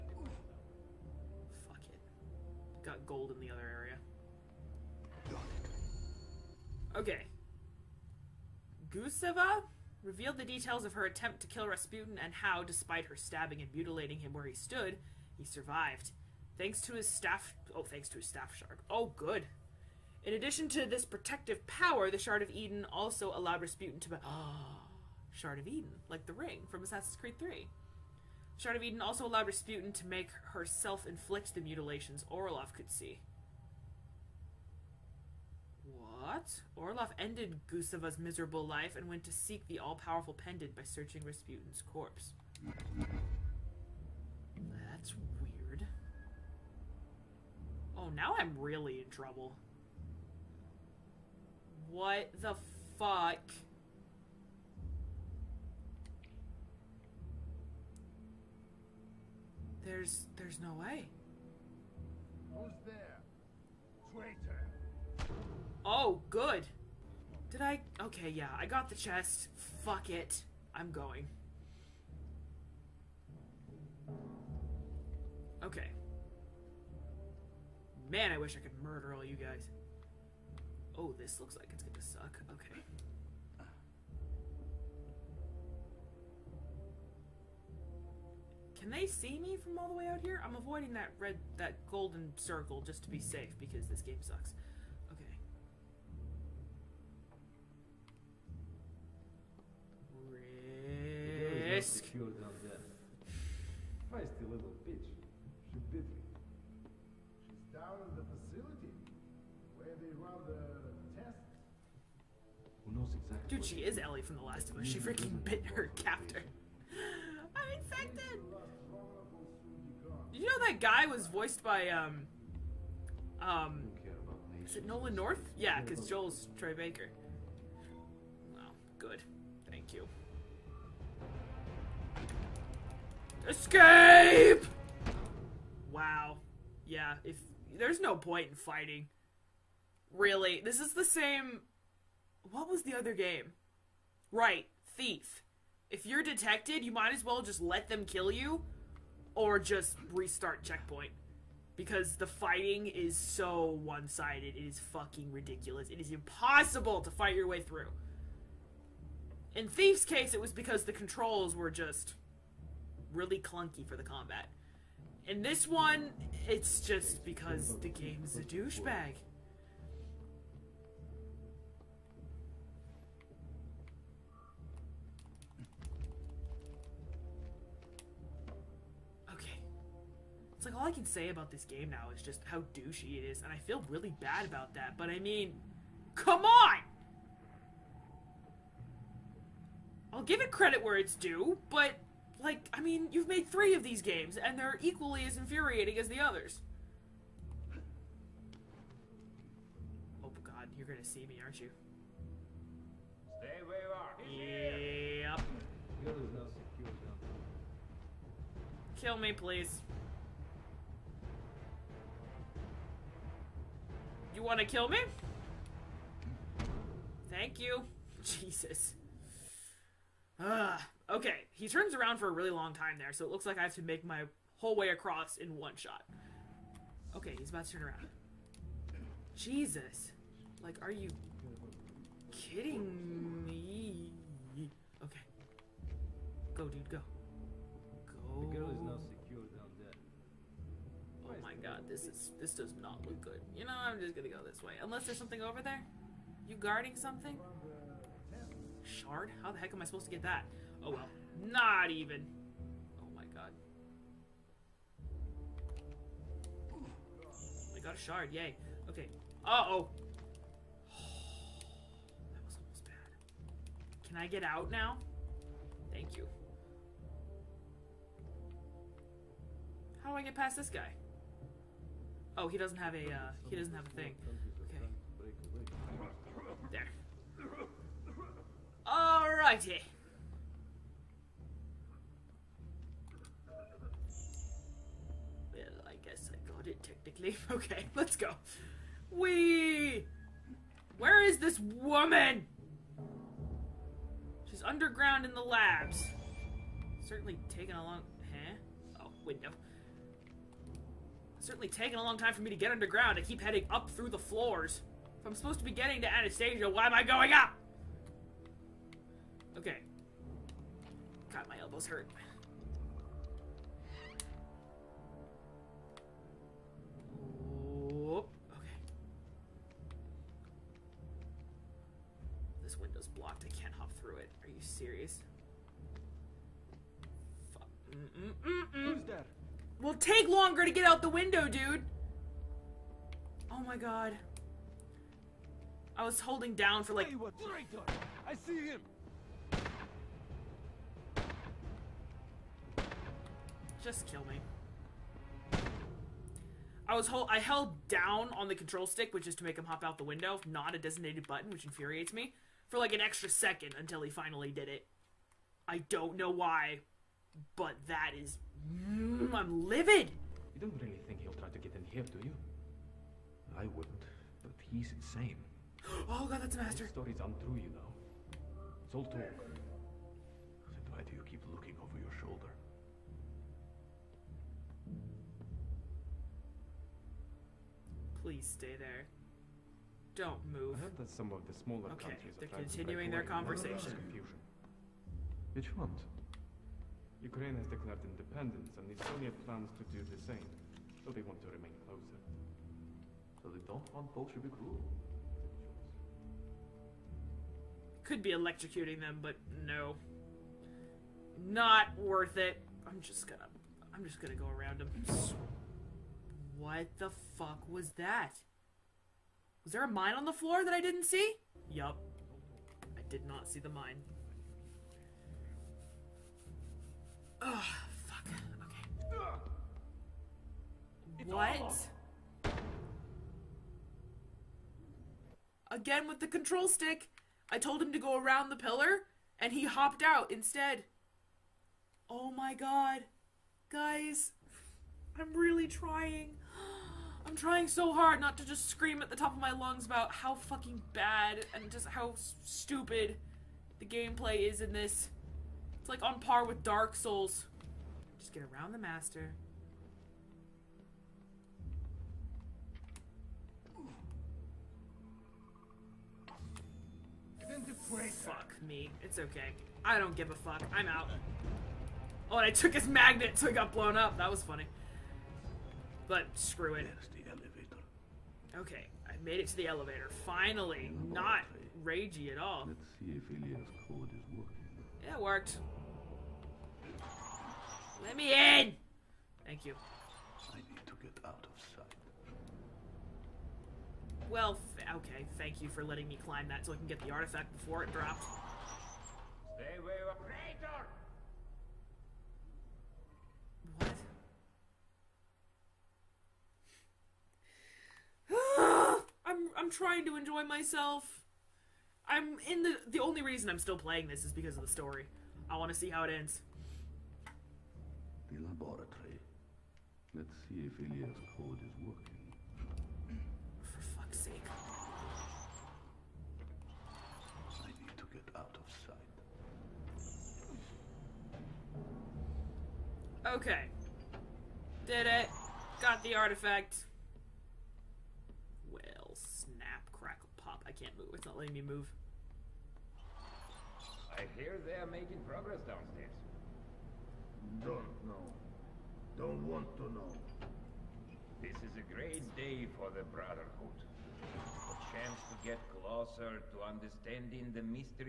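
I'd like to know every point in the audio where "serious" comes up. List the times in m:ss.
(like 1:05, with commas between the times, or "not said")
5:24.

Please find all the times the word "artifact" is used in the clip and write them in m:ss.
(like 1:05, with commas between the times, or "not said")
8:07, 8:46.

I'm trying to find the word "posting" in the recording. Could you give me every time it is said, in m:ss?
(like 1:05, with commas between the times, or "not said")
not said.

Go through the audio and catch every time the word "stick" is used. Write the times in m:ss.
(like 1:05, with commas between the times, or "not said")
5:48, 7:06.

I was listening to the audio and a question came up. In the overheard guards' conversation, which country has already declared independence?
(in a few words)
Ukraine.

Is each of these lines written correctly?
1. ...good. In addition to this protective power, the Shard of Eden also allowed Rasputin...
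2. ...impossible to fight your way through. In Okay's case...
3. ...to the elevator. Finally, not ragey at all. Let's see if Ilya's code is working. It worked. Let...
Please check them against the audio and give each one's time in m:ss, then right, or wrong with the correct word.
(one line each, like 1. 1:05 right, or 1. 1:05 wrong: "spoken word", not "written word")
1. 0:19 right
2. 2:36 wrong: "Thief", not "Okay"
3. 7:49 right.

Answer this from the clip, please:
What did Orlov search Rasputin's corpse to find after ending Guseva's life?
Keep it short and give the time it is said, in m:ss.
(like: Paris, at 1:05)
The all-powerful pendant, at 0:39.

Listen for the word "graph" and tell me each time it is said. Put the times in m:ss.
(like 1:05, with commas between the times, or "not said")
not said.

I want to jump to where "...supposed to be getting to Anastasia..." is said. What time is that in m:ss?
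5:05.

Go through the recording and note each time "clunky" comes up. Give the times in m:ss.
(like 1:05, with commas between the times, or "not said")
2:43.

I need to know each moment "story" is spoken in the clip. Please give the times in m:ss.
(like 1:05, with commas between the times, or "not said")
6:06, 8:24.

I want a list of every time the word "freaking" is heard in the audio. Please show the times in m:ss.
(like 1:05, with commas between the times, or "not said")
1:54.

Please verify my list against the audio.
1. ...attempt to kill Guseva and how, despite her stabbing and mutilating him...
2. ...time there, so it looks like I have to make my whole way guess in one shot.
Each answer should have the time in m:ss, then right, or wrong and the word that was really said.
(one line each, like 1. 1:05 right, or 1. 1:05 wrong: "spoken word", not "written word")
1. 0:11 wrong: "Rasputin", not "Guseva"
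2. 3:42 wrong: "across", not "guess".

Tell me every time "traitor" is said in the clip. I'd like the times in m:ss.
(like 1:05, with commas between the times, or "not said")
1:04, 8:13.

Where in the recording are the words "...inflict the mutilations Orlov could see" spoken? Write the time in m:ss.
0:31.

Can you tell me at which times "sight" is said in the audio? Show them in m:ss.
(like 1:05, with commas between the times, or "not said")
8:01, 8:39.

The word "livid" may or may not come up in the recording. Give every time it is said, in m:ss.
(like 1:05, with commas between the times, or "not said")
5:59.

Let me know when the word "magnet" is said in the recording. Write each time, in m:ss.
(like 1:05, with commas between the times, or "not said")
7:42.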